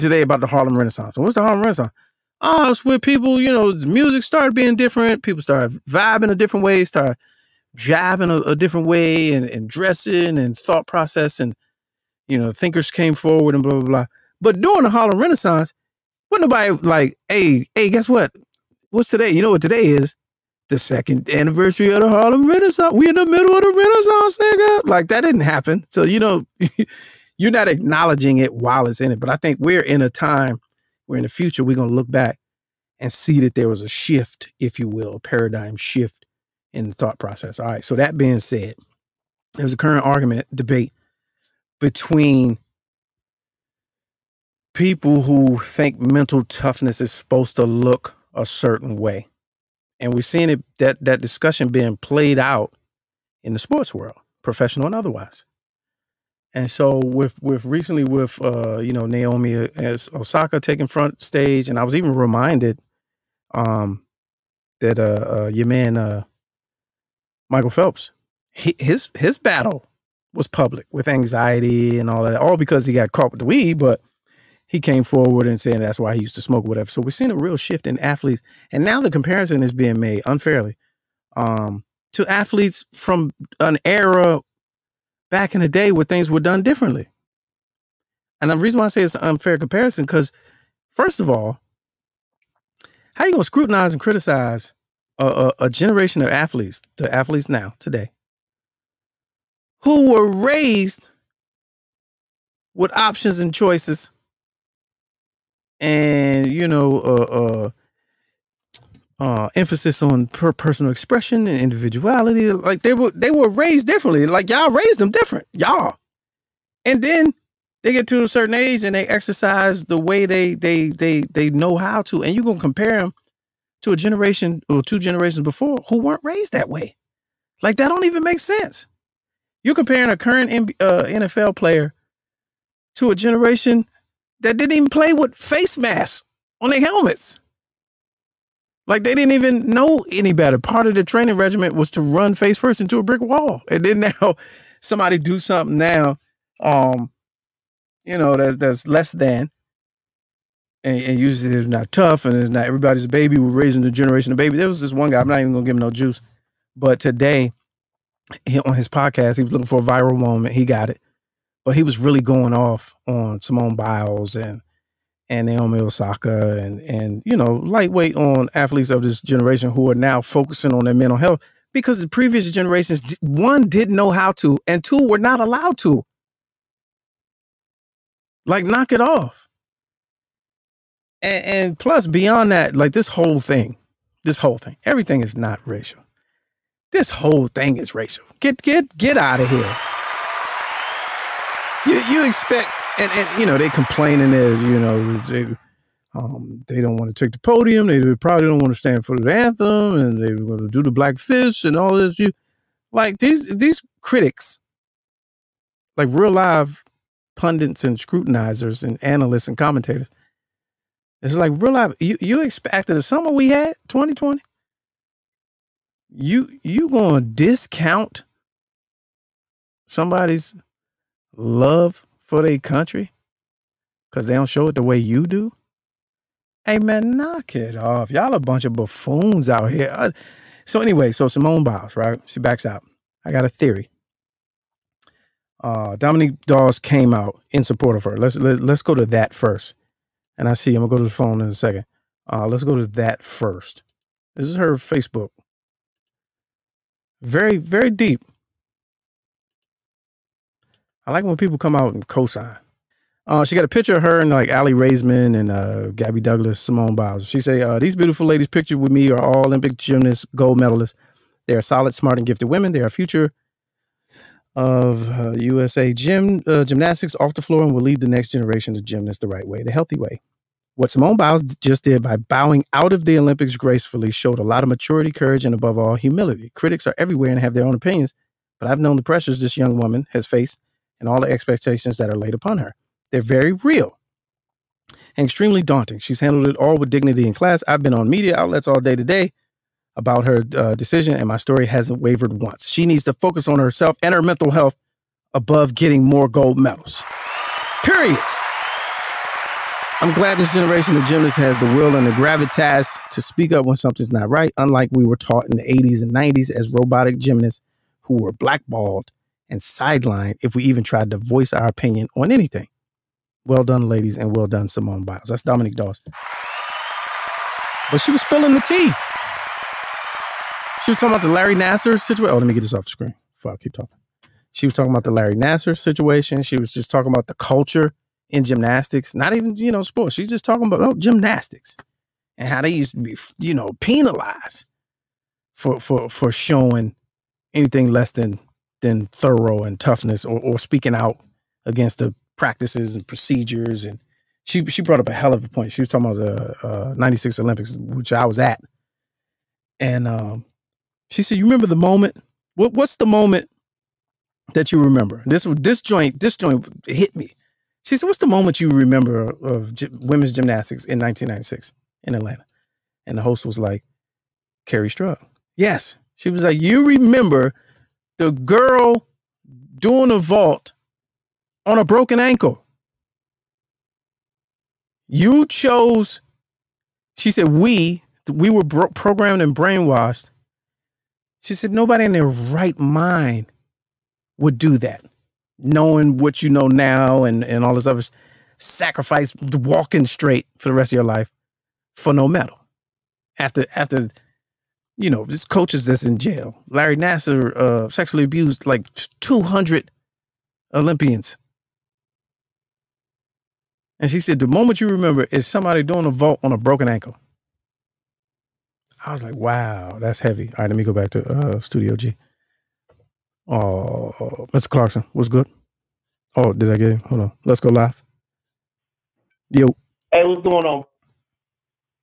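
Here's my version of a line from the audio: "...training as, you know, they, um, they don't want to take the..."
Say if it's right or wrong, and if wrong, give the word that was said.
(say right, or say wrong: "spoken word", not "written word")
wrong: "complaining", not "training".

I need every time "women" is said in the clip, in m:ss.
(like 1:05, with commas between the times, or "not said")
4:22, 5:59.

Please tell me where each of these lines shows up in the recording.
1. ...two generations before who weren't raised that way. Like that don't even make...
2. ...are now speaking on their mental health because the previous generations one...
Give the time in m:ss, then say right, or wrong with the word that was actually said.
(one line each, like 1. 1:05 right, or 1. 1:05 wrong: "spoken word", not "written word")
1. 2:04 right
2. 2:49 wrong: "focusing", not "speaking".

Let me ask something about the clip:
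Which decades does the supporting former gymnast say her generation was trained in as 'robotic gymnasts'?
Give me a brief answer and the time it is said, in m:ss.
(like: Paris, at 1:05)
80s and 90s, at 5:05.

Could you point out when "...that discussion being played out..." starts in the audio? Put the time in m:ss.
0:51.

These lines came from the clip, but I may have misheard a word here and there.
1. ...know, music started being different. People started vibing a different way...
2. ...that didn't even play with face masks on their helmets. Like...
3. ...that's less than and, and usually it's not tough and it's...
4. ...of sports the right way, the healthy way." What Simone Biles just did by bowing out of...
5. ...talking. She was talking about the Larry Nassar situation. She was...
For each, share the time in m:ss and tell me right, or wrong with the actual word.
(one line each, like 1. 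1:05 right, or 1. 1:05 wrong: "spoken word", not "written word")
1. 0:03 right
2. 2:14 right
3. 2:28 right
4. 4:28 wrong: "gymnasts", not "sports"
5. 5:23 right.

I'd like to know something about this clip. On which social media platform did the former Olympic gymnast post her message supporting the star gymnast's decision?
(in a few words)
Facebook.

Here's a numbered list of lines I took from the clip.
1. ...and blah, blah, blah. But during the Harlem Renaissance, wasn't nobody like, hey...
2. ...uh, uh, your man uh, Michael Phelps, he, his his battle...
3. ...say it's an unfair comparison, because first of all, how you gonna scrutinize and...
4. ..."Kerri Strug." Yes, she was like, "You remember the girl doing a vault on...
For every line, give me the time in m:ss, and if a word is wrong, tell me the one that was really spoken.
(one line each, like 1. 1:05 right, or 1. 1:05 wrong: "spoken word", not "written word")
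1. 0:13 right
2. 1:04 right
3. 1:28 right
4. 6:04 right.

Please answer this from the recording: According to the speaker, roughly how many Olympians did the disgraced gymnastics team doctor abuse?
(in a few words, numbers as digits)
200.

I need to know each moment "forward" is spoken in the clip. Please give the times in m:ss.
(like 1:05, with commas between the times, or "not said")
0:13, 1:15.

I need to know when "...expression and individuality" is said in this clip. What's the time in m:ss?
1:50.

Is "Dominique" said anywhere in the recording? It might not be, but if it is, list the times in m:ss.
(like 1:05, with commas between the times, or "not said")
3:55, 5:15.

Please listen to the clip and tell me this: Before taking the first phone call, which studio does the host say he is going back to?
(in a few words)
Studio G.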